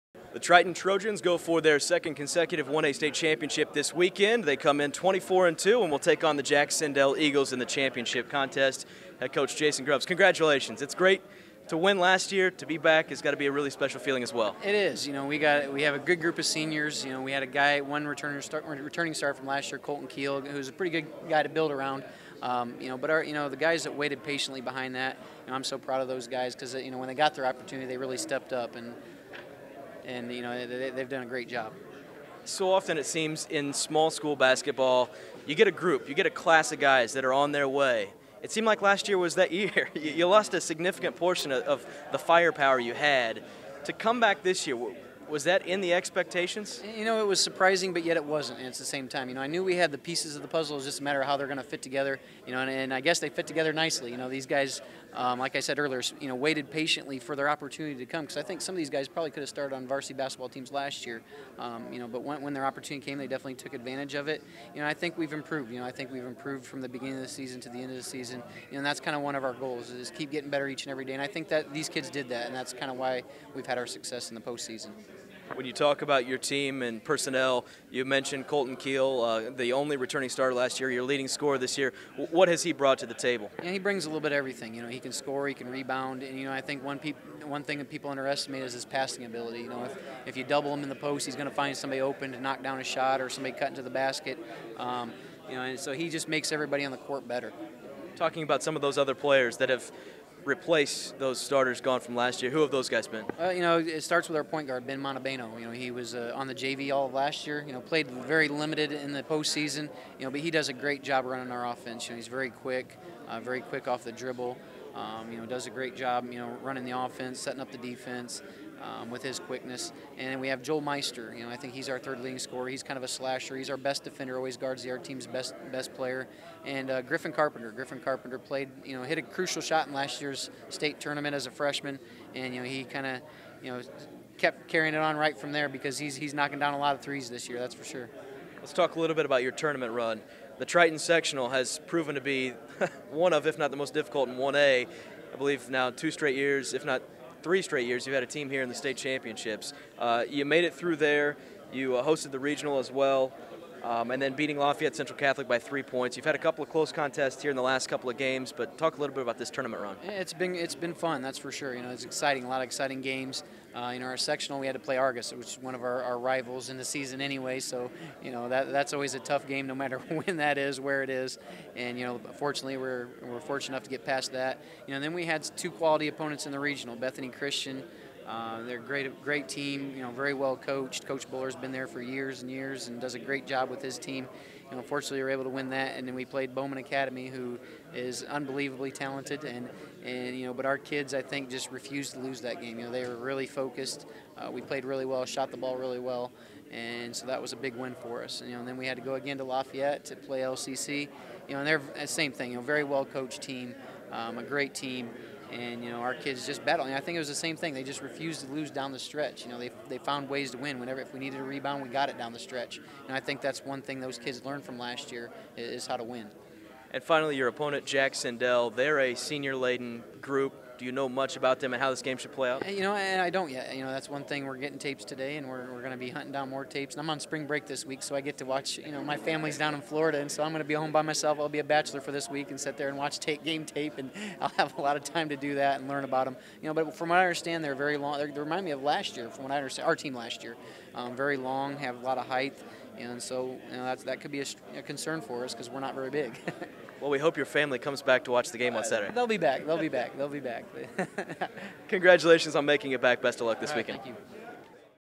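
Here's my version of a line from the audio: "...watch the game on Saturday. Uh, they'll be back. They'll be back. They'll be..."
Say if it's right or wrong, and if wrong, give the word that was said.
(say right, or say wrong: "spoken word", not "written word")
right.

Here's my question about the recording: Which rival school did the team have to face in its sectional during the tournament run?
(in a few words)
Argos.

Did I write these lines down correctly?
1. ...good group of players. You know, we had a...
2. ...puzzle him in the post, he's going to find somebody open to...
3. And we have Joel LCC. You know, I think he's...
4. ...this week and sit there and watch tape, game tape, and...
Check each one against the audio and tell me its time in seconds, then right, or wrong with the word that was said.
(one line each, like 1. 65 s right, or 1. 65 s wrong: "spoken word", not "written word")
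1. 15 s wrong: "seniors", not "players"
2. 90 s wrong: "double", not "puzzle"
3. 120 s wrong: "Meister", not "LCC"
4. 232 s right.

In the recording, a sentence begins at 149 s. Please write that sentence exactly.
Uh, you made it through there.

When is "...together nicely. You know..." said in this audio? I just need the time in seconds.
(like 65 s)
53 s.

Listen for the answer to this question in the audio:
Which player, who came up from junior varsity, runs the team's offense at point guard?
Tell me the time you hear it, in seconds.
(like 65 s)
104 s.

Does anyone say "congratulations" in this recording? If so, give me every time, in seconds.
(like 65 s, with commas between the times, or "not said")
10 s, 251 s.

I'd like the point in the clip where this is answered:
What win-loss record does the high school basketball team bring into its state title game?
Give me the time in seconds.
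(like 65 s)
4 s.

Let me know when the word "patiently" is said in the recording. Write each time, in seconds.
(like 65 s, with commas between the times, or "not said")
24 s, 56 s.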